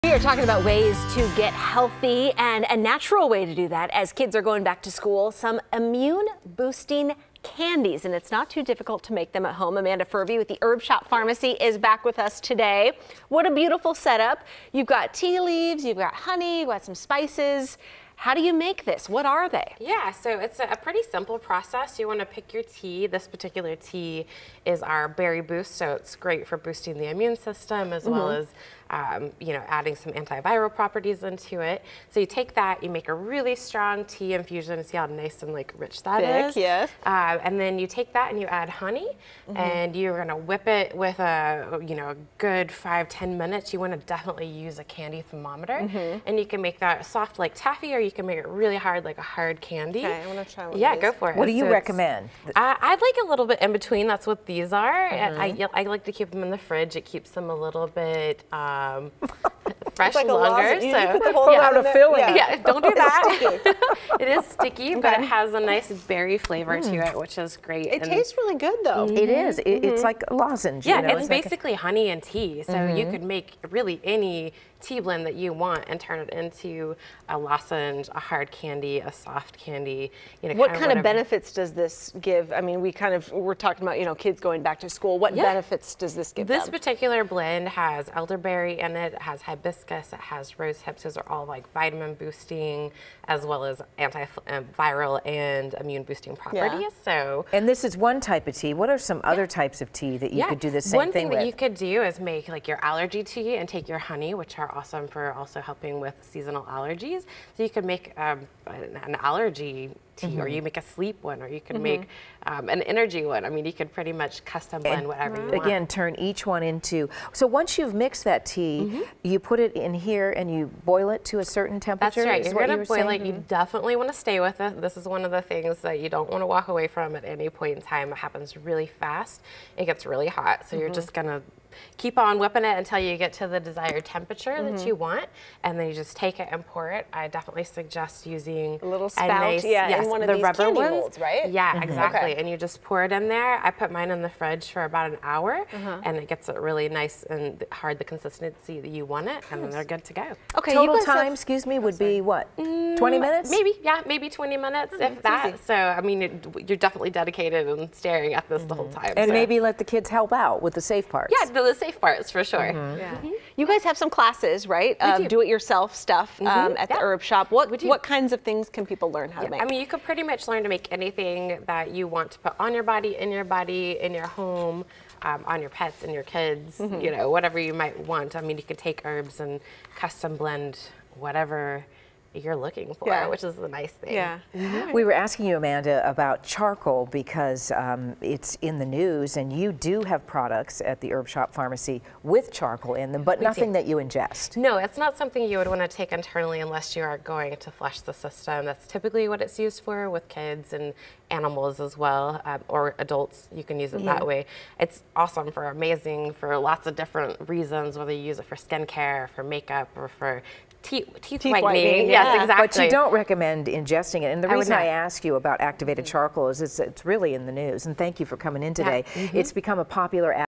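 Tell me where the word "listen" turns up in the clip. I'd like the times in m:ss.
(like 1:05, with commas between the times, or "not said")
not said.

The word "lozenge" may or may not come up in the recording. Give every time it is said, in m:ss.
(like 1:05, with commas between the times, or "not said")
1:10, 1:17.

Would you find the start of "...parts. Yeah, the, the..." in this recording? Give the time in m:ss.
2:41.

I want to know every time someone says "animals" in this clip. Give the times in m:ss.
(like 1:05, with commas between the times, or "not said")
3:21.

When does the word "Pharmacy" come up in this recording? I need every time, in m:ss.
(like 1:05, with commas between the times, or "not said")
0:11, 3:11.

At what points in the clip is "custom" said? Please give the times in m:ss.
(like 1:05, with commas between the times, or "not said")
1:54, 3:00.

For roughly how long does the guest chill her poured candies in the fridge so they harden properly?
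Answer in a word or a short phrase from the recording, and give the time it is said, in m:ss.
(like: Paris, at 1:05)
about an hour, at 2:24.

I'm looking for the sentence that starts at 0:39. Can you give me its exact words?
and you're gonna whip it with a you know a good five ten minutes.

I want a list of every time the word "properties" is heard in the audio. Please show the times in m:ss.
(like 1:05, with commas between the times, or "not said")
0:30, 1:36.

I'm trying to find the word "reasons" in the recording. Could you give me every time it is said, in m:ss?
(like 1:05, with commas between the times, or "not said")
3:27, 3:34.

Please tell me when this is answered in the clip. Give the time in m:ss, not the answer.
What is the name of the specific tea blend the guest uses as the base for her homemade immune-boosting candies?
0:25.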